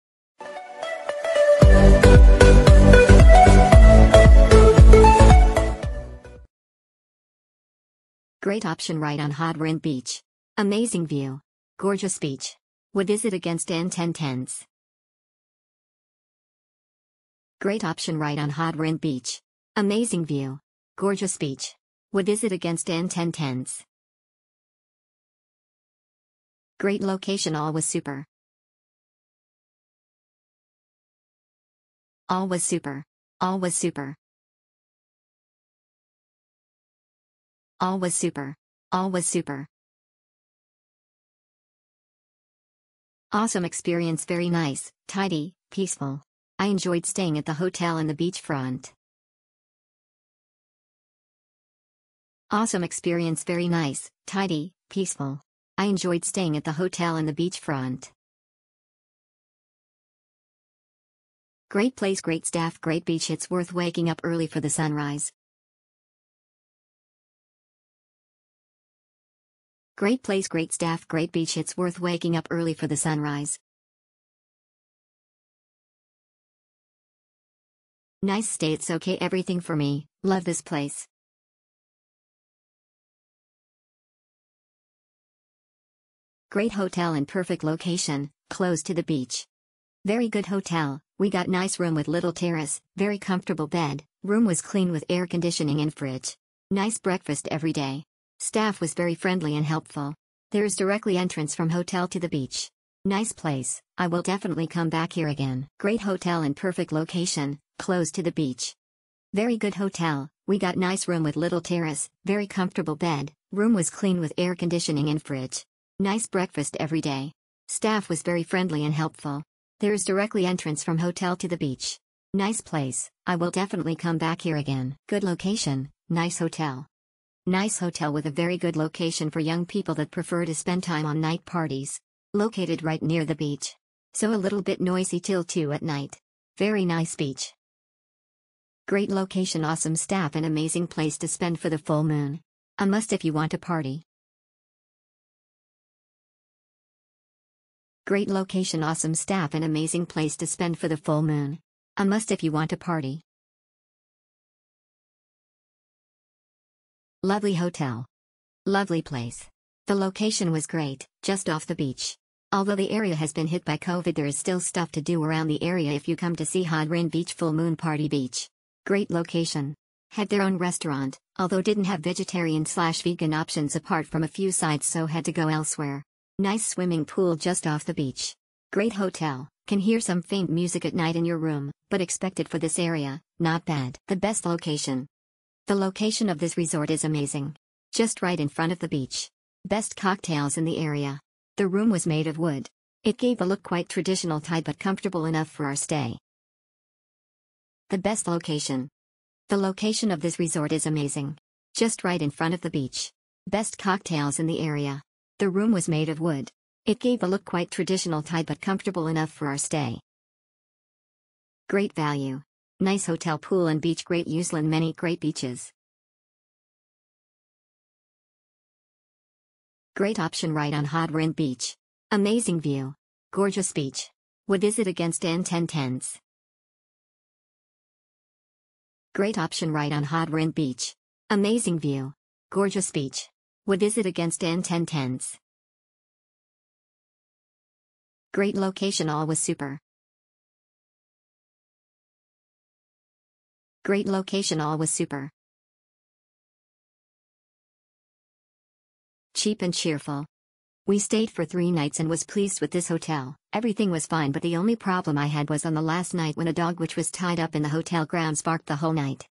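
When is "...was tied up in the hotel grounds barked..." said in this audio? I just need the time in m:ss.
4:16.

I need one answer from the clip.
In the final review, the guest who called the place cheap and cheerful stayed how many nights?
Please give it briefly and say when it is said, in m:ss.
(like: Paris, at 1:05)
3, at 4:11.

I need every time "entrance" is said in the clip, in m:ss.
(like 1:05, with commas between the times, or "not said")
1:41, 2:00.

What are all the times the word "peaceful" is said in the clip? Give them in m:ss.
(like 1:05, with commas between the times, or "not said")
0:45, 0:54.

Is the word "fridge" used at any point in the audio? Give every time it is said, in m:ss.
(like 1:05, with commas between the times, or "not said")
1:35, 1:55.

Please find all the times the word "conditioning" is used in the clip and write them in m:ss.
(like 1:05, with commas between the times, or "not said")
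1:35, 1:54.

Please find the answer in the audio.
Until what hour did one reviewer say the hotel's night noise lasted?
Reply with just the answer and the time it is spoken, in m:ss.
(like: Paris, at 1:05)
2, at 2:15.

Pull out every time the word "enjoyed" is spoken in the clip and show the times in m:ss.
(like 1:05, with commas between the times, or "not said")
0:46, 0:55.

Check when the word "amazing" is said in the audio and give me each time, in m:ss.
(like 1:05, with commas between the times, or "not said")
0:10, 0:19, 2:20, 2:29, 3:07, 3:20, 3:42, 3:51.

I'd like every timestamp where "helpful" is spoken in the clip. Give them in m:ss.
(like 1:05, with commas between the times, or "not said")
1:39, 1:58.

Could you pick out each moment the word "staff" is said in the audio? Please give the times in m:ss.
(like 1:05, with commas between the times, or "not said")
1:02, 1:10, 1:38, 1:57, 2:19, 2:29.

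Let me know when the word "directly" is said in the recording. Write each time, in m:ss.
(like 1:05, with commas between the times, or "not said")
1:40, 2:00.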